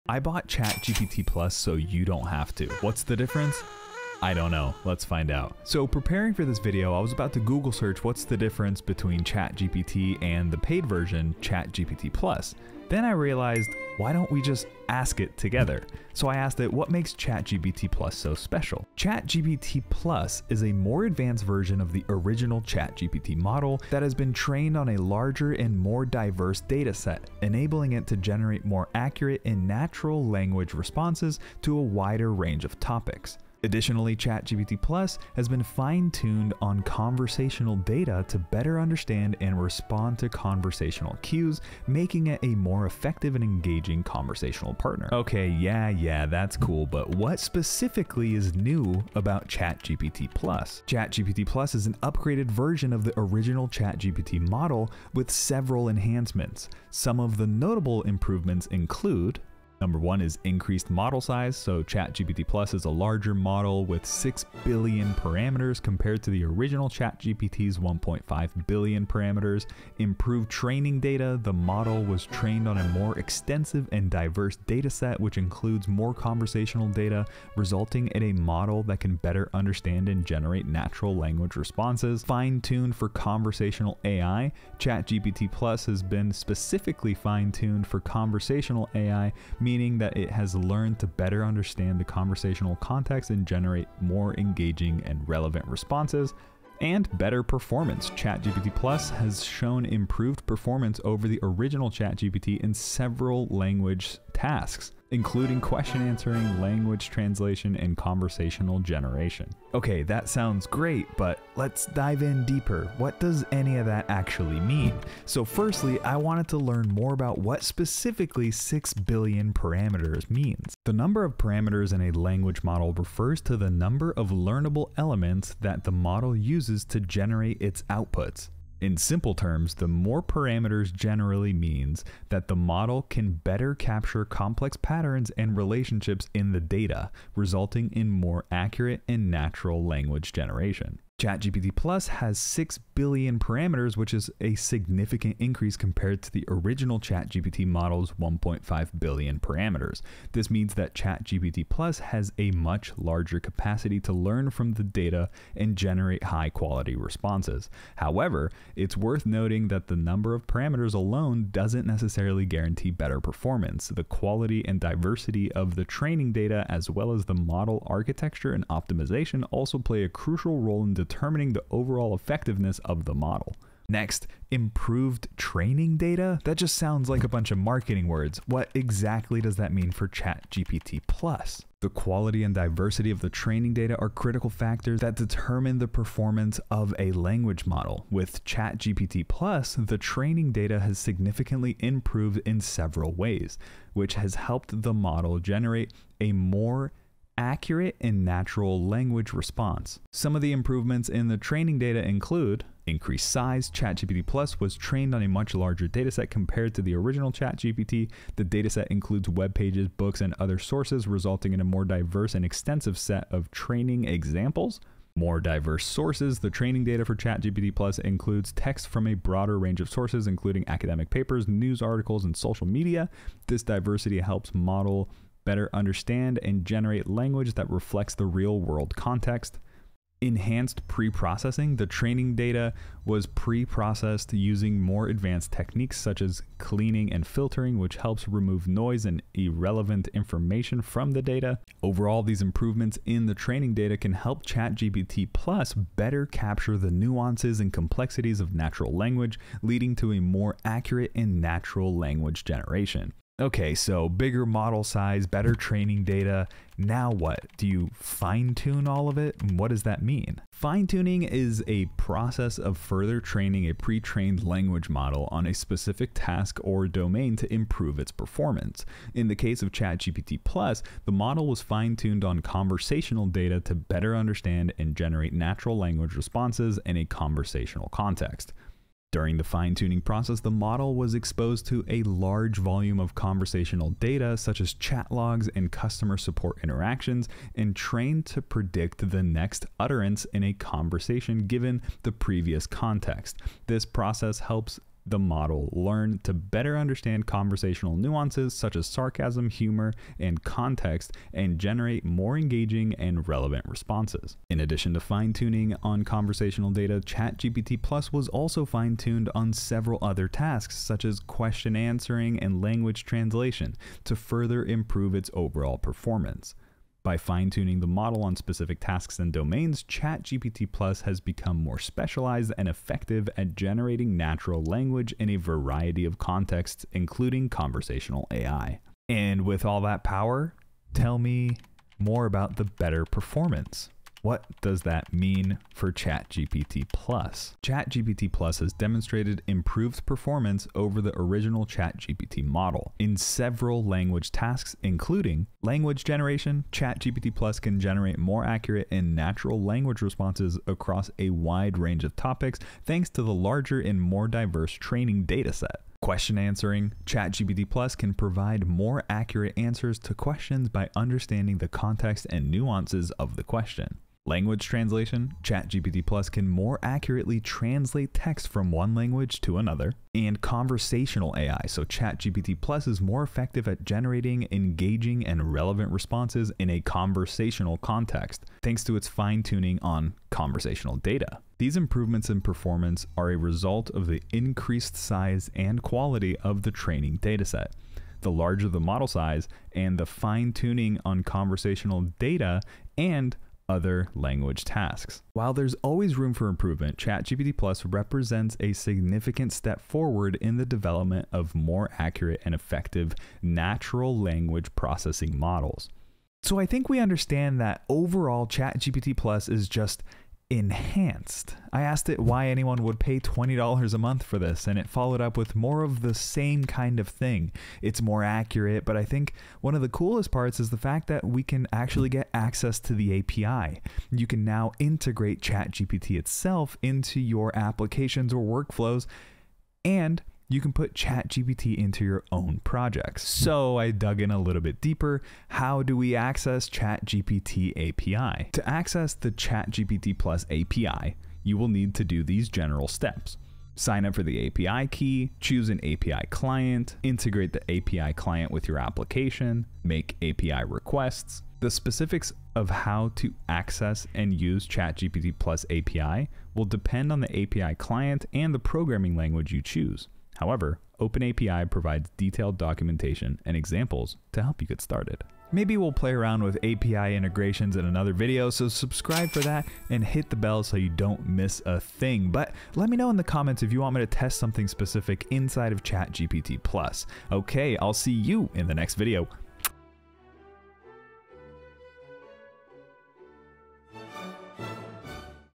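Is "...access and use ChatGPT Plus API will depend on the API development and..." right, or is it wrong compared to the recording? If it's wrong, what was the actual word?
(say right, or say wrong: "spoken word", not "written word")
wrong: "client", not "development".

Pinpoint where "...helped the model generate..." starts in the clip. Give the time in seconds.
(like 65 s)
194 s.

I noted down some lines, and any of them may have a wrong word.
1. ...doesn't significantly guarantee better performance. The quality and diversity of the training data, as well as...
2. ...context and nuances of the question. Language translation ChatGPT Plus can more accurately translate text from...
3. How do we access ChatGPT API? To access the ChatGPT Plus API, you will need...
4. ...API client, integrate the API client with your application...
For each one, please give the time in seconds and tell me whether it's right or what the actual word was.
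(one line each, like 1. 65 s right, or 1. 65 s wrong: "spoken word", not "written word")
1. 161 s wrong: "necessarily", not "significantly"
2. 361 s right
3. 435 s right
4. 445 s right.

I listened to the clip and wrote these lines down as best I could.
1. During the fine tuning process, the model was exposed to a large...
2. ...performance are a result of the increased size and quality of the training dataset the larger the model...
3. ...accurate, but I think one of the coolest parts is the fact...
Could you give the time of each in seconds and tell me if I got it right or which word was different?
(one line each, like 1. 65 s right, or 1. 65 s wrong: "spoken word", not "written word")
1. 279 s right
2. 382 s right
3. 418 s right.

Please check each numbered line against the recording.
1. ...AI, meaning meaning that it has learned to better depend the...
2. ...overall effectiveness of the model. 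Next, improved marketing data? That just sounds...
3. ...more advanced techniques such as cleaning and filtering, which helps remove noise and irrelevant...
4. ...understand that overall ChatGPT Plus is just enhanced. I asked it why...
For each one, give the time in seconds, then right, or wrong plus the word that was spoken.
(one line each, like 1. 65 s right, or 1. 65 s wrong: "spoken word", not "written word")
1. 88 s wrong: "understand", not "depend"
2. 171 s wrong: "training", not "marketing"
3. 234 s right
4. 406 s right.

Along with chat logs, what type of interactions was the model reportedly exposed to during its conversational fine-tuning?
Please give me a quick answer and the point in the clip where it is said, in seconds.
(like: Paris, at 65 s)
customer support interactions, at 285 s.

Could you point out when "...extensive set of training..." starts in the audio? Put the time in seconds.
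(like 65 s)
212 s.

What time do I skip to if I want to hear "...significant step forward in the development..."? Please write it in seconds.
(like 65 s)
398 s.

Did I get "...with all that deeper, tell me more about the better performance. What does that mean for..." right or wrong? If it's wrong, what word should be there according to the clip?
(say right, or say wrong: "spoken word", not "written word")
wrong: "power", not "deeper".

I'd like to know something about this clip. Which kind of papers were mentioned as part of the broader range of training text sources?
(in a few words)
academic papers.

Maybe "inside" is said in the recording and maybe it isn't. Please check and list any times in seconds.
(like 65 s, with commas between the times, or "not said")
475 s.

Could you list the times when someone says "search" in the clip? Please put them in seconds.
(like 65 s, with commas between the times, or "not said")
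7 s.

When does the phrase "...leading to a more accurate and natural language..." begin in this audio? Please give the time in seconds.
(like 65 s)
249 s.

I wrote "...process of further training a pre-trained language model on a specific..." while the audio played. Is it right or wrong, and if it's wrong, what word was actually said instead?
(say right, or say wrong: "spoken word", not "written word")
right.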